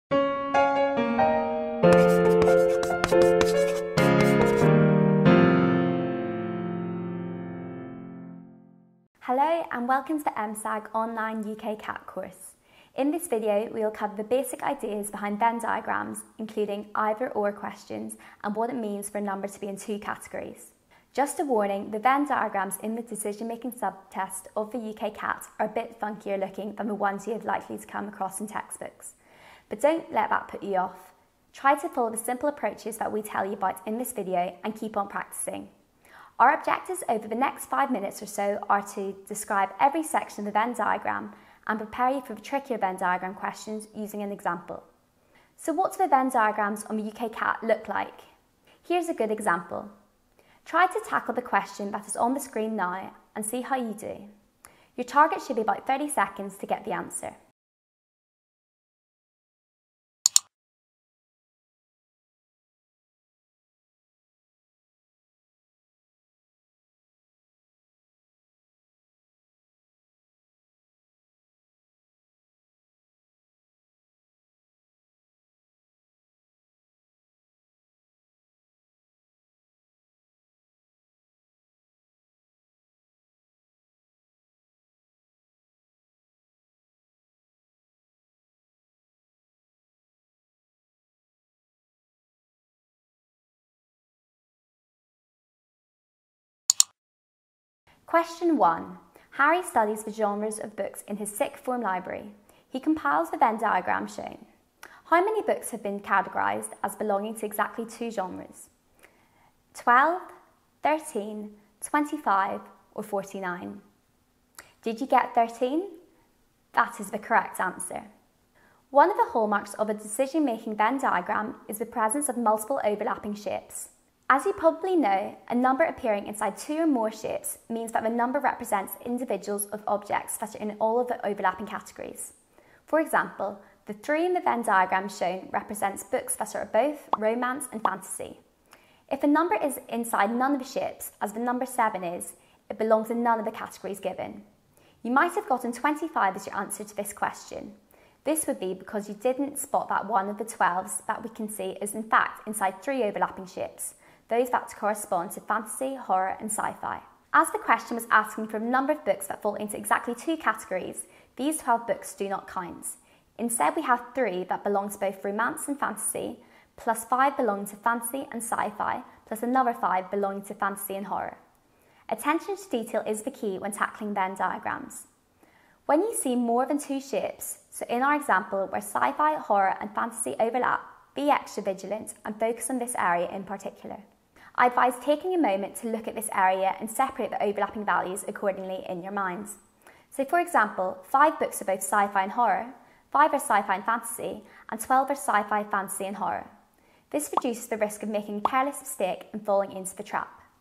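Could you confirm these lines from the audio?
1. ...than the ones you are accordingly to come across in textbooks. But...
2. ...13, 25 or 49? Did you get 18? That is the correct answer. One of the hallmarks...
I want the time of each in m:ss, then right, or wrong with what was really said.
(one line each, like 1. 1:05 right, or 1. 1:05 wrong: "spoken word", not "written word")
1. 0:26 wrong: "likely", not "accordingly"
2. 1:50 wrong: "13", not "18".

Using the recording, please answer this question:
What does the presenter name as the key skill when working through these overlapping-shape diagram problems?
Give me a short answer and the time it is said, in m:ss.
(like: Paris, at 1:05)
Attention to detail, at 2:52.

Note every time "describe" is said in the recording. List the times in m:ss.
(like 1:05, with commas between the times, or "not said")
0:39.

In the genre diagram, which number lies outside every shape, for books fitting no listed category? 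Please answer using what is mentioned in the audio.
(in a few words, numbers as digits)
7.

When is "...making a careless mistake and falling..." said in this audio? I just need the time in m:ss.
3:18.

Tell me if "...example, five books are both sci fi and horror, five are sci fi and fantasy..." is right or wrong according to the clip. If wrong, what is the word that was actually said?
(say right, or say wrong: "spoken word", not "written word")
right.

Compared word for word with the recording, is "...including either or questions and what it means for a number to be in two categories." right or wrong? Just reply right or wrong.
right.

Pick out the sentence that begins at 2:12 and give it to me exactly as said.
For example, the three in the Venn diagram shown represents books that are both romance and fantasy.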